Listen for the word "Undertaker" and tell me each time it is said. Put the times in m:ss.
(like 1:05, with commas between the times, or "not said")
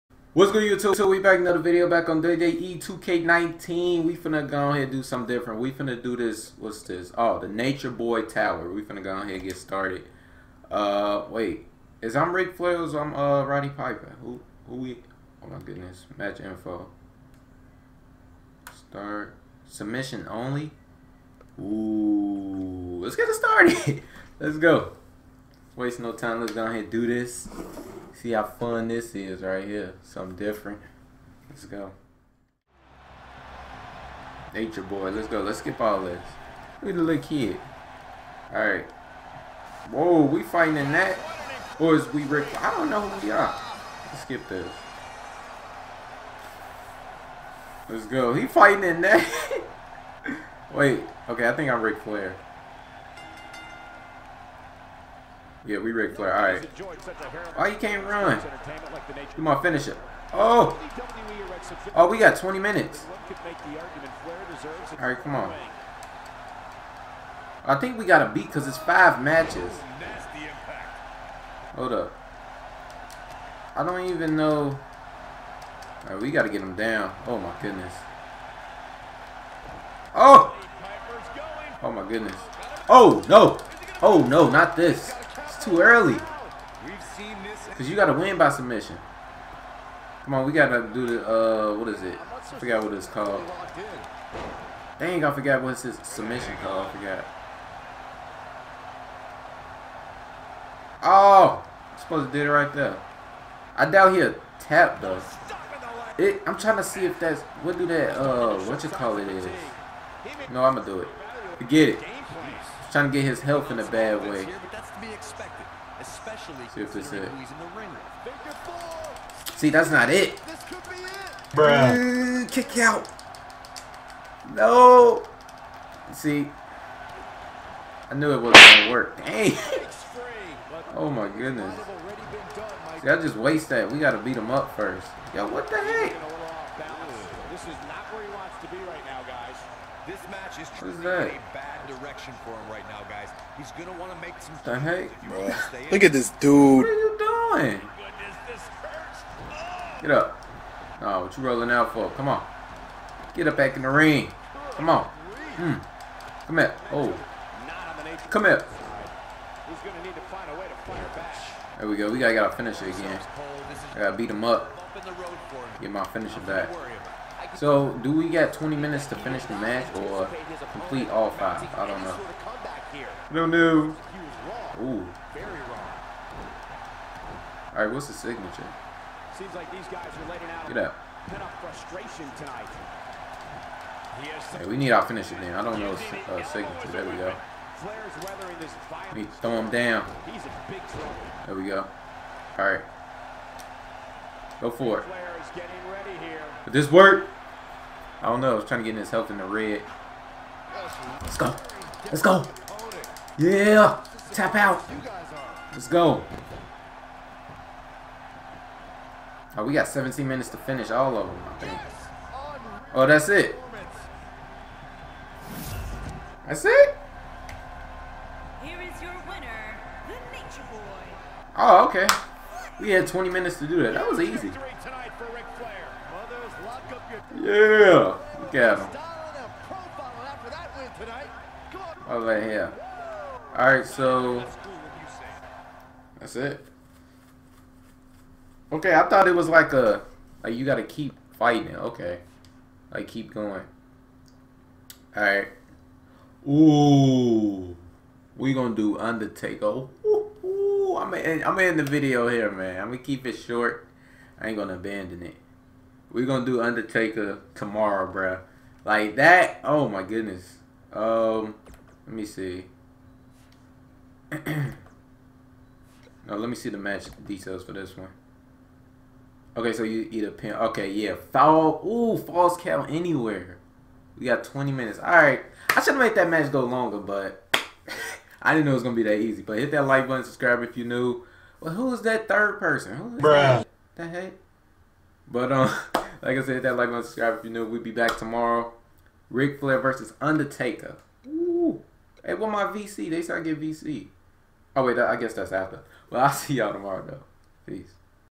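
4:08, 4:16, 4:50.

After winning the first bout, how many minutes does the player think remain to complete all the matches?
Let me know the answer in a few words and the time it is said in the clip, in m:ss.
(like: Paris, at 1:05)
17, at 3:29.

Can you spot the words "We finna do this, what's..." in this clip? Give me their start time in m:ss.
0:05.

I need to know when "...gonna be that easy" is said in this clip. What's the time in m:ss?
4:38.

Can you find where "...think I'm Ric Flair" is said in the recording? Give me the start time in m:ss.
0:51.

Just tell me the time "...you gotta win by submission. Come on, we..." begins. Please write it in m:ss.
1:27.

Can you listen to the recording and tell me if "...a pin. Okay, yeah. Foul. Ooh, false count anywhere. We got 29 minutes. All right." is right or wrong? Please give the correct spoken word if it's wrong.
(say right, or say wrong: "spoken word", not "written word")
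wrong: "20", not "29".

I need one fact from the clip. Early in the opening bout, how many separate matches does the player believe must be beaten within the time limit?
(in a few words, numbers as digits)
5.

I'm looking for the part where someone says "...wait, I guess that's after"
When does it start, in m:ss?
4:54.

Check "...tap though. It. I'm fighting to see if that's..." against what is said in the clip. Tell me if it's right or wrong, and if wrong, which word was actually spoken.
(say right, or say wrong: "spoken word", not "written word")
wrong: "trying", not "fighting".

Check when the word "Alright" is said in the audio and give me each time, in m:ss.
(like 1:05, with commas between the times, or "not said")
0:38, 3:53, 4:05.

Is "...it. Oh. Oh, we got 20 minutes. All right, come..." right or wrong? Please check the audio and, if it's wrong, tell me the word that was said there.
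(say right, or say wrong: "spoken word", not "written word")
right.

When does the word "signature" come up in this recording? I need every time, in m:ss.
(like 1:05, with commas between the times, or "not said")
2:58, 3:06.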